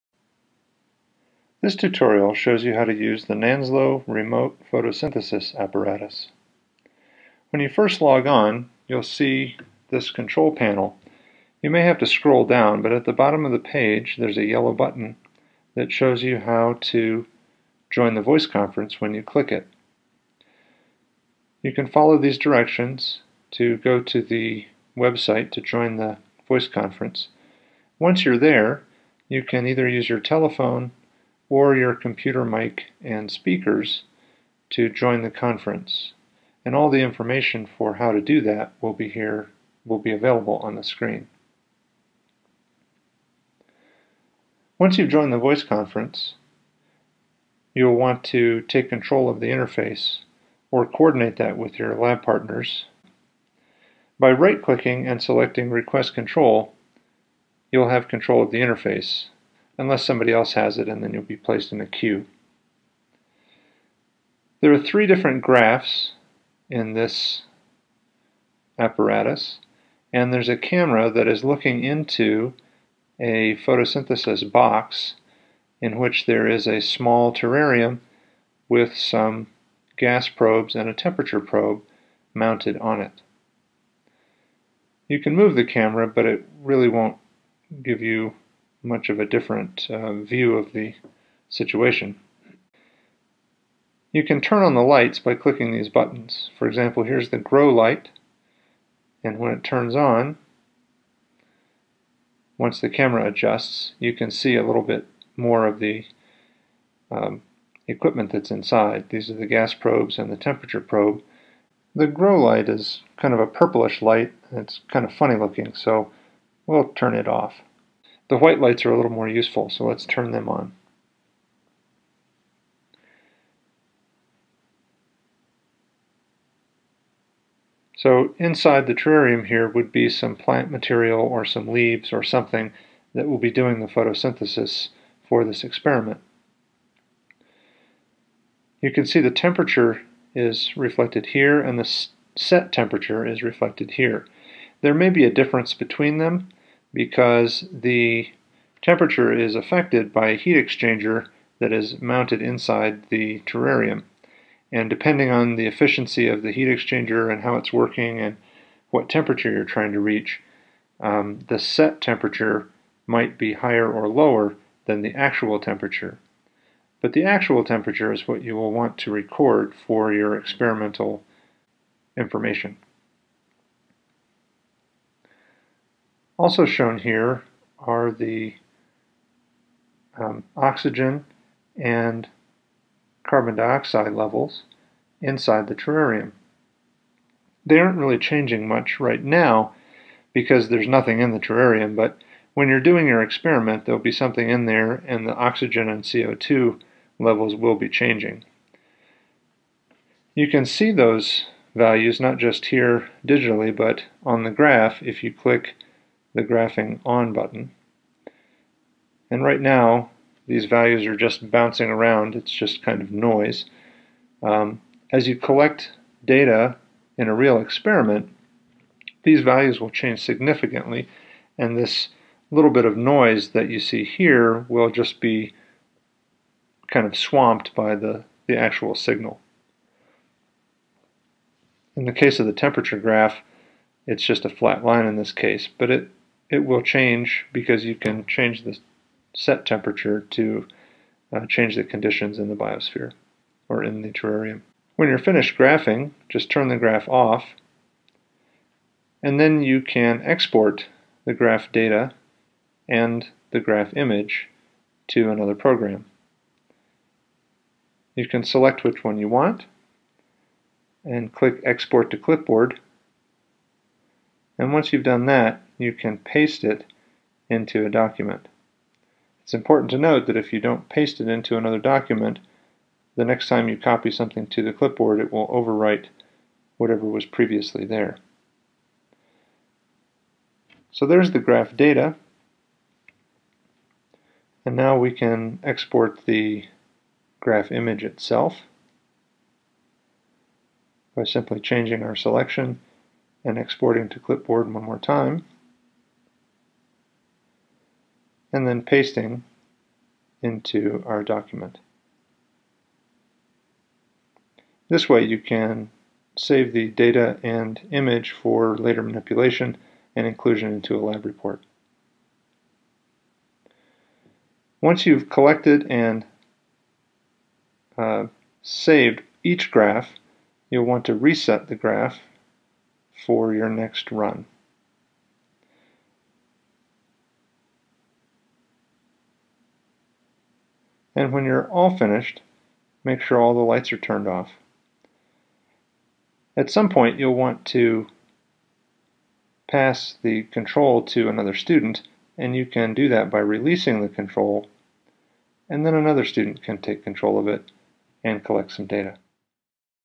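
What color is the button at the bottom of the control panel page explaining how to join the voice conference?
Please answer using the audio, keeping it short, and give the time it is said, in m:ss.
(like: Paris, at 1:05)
Yellow, at 0:14.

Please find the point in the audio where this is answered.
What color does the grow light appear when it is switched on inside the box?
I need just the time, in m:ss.
1:53.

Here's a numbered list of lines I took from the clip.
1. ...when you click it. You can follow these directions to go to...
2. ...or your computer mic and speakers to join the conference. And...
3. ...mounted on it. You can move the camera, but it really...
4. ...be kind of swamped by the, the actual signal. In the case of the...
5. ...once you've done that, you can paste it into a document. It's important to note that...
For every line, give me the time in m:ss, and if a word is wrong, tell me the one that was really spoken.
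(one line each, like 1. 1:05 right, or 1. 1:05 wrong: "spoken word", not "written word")
1. 0:18 right
2. 0:31 right
3. 1:22 right
4. 3:45 right
5. 4:24 right.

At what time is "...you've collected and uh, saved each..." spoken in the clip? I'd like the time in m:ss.
5:15.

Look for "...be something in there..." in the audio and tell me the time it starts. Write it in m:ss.
3:14.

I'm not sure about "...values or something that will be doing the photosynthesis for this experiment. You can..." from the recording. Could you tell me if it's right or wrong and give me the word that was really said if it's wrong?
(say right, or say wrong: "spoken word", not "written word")
wrong: "leaves", not "values".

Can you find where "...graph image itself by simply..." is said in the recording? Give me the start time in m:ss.
4:47.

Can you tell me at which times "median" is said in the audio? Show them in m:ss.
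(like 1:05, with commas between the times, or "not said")
not said.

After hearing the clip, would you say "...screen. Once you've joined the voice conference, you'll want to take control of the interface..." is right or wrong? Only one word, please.
right.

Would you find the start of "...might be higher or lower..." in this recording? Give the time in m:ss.
2:43.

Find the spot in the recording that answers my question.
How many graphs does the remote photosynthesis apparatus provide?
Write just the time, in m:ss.
1:04.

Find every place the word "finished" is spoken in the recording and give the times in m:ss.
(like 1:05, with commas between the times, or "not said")
4:05, 5:31.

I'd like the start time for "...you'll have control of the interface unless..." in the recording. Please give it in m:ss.
0:57.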